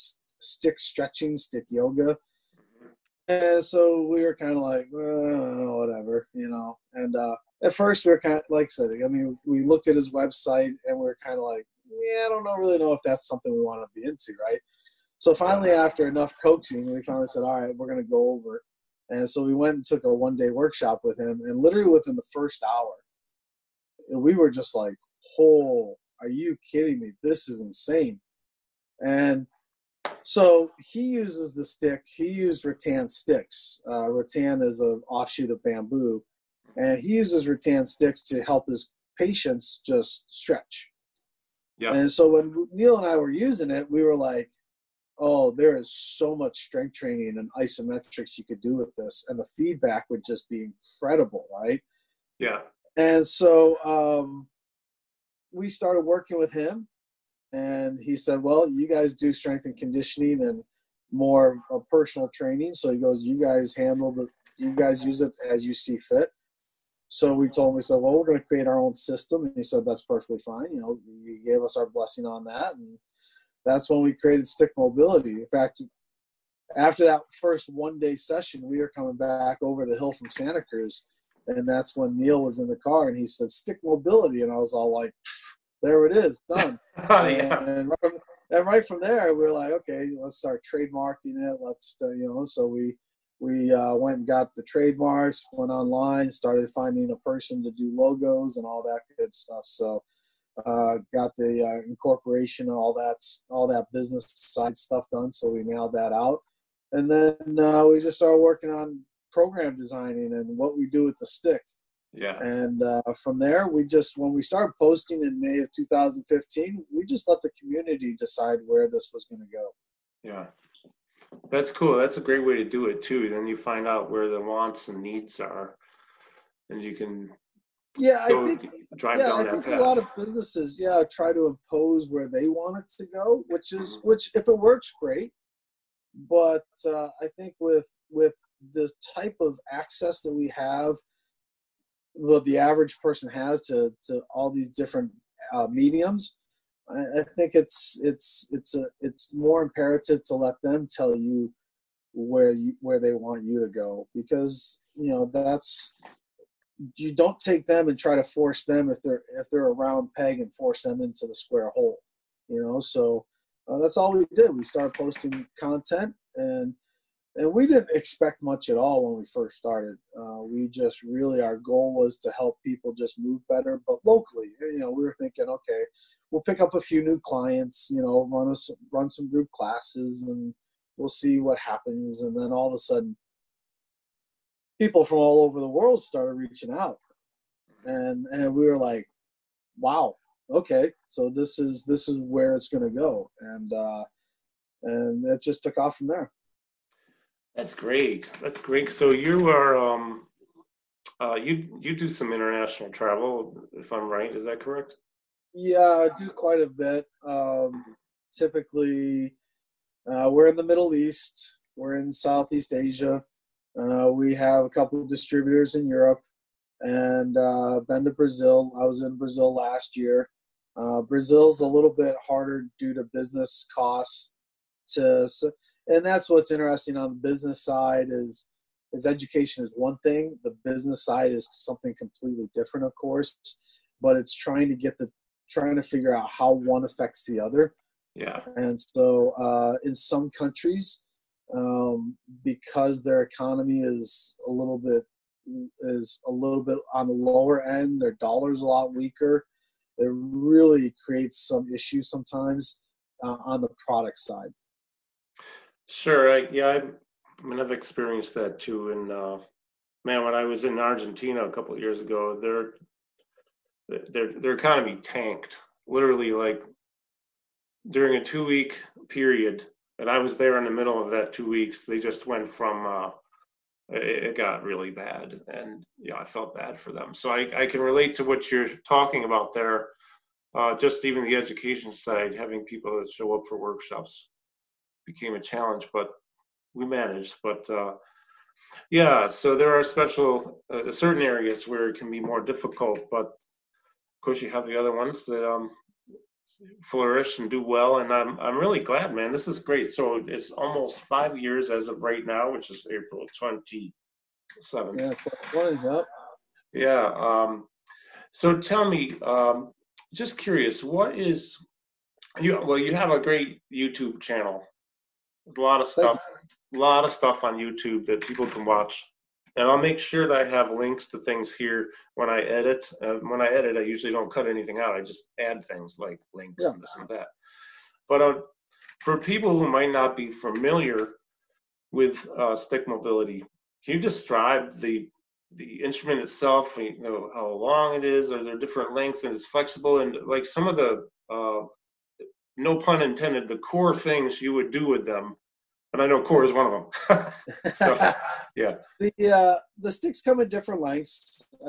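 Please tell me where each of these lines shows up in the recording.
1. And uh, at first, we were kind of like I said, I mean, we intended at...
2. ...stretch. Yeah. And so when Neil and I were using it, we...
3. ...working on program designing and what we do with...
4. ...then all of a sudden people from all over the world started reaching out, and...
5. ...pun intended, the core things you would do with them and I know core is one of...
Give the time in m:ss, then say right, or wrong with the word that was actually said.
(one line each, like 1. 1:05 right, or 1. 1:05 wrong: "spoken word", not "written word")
1. 0:06 wrong: "looked", not "intended"
2. 0:40 right
3. 1:48 right
4. 3:02 right
5. 5:42 right.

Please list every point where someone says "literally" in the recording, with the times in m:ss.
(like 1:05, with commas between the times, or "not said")
0:21, 4:25.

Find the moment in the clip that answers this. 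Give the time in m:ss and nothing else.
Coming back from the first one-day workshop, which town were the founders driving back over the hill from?
1:20.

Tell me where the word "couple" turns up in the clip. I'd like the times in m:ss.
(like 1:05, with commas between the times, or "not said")
3:34, 4:21.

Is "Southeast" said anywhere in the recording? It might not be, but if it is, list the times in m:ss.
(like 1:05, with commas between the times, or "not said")
3:32.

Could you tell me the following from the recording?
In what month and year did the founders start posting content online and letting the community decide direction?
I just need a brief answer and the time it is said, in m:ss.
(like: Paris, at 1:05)
May 2015, at 1:55.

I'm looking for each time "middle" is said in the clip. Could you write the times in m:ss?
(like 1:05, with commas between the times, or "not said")
3:30, 4:30.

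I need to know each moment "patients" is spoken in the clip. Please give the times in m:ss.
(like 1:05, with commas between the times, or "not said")
0:39.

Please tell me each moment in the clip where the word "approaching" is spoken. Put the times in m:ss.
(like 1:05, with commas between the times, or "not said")
not said.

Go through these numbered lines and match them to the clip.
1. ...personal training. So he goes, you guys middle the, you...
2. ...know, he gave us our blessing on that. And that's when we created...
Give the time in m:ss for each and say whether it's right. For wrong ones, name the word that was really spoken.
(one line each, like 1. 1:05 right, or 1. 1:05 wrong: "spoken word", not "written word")
1. 1:01 wrong: "handle", not "middle"
2. 1:10 right.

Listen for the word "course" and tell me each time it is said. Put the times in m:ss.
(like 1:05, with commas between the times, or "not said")
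3:52, 4:54.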